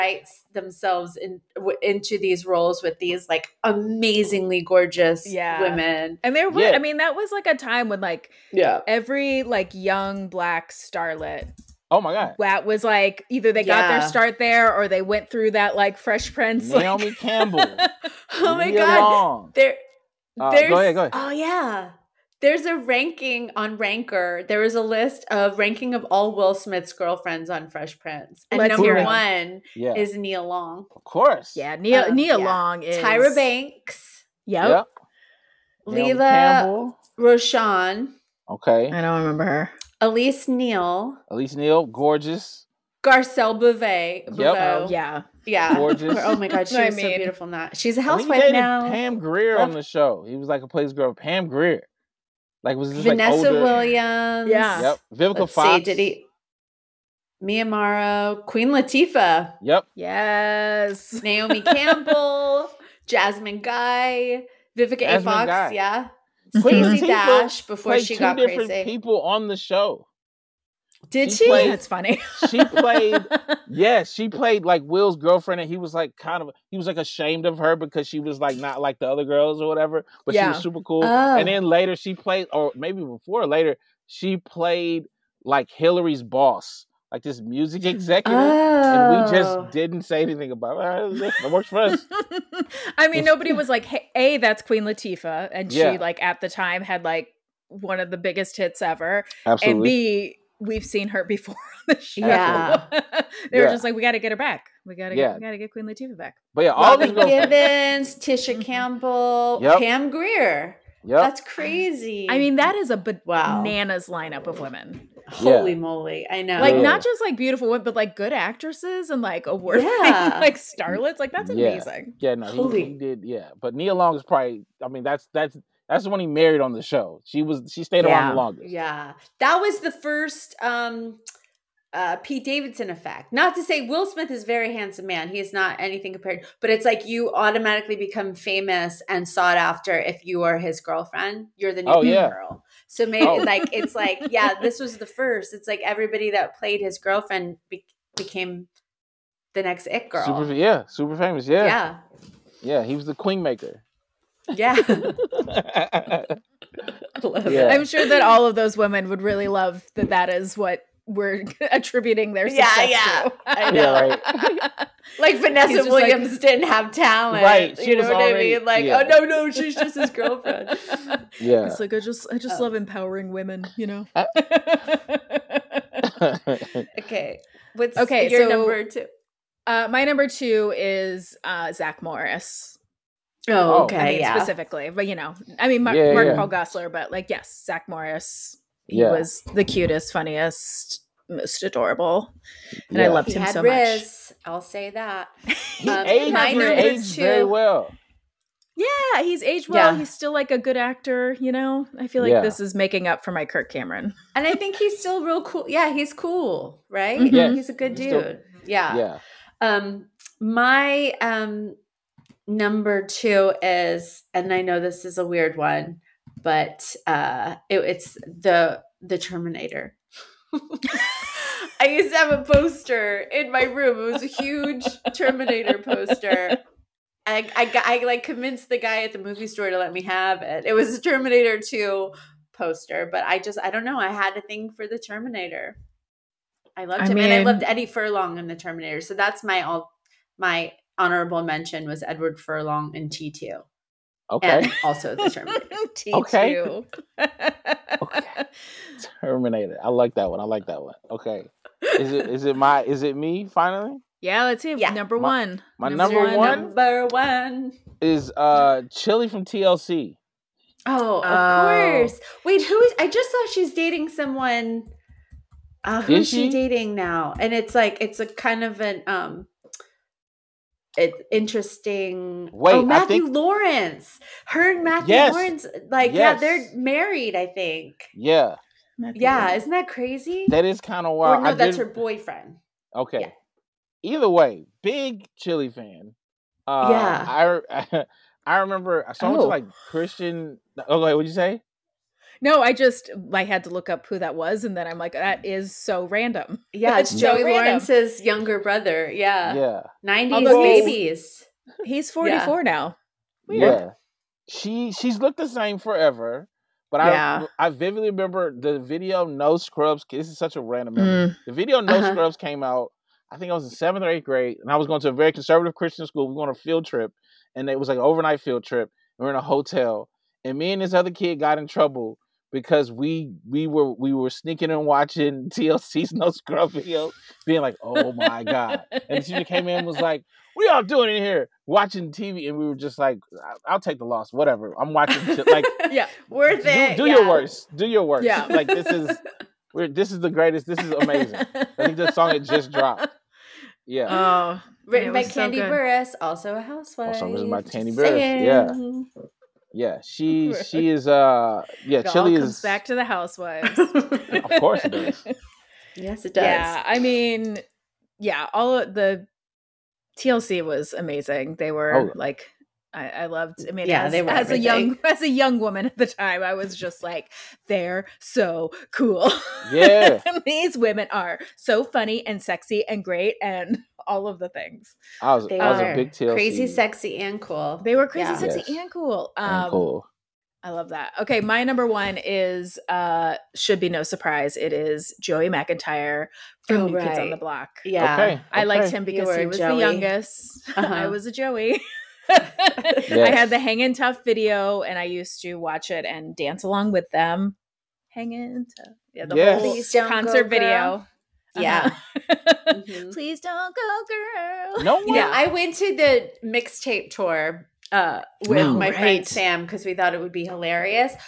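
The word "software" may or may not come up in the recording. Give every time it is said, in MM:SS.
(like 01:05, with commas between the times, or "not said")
not said.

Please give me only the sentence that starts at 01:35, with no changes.
she like at the time had like one of the biggest hits ever, Absolutely.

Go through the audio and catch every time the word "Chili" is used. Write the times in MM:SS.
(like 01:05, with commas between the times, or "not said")
04:18, 04:45, 05:52.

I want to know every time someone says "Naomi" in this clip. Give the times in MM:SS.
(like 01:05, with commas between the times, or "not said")
00:16, 01:01.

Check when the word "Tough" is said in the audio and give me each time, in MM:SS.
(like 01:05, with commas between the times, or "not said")
06:33, 06:38.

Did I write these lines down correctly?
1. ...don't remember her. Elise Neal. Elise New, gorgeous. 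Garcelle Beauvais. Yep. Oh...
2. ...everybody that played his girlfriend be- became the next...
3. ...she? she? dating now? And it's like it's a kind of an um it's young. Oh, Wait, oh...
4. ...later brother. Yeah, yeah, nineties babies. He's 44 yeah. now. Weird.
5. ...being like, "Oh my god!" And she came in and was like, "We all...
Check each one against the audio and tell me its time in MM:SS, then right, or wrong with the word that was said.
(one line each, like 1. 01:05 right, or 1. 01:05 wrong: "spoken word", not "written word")
1. 00:39 wrong: "Neal", not "New"
2. 02:25 right
3. 04:26 wrong: "interesting", not "young"
4. 04:58 wrong: "younger", not "later"
5. 05:27 right.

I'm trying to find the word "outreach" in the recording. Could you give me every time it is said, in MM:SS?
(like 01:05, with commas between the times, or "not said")
not said.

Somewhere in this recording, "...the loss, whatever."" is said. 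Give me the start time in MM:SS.
05:33.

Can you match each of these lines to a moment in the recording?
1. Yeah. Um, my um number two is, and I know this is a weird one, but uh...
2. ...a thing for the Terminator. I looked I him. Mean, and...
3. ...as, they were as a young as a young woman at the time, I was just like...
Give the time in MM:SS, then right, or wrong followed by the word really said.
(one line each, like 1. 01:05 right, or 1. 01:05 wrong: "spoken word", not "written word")
1. 03:28 right
2. 03:54 wrong: "loved", not "looked"
3. 06:04 right.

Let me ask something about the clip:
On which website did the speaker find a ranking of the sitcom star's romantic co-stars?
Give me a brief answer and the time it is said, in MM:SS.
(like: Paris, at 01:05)
Ranker, at 00:23.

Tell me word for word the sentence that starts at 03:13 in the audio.
I loved he him so Riz, much.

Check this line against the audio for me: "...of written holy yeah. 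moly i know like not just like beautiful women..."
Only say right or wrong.
wrong.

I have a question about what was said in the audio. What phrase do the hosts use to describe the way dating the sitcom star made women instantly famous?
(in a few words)
Pete Davidson effect.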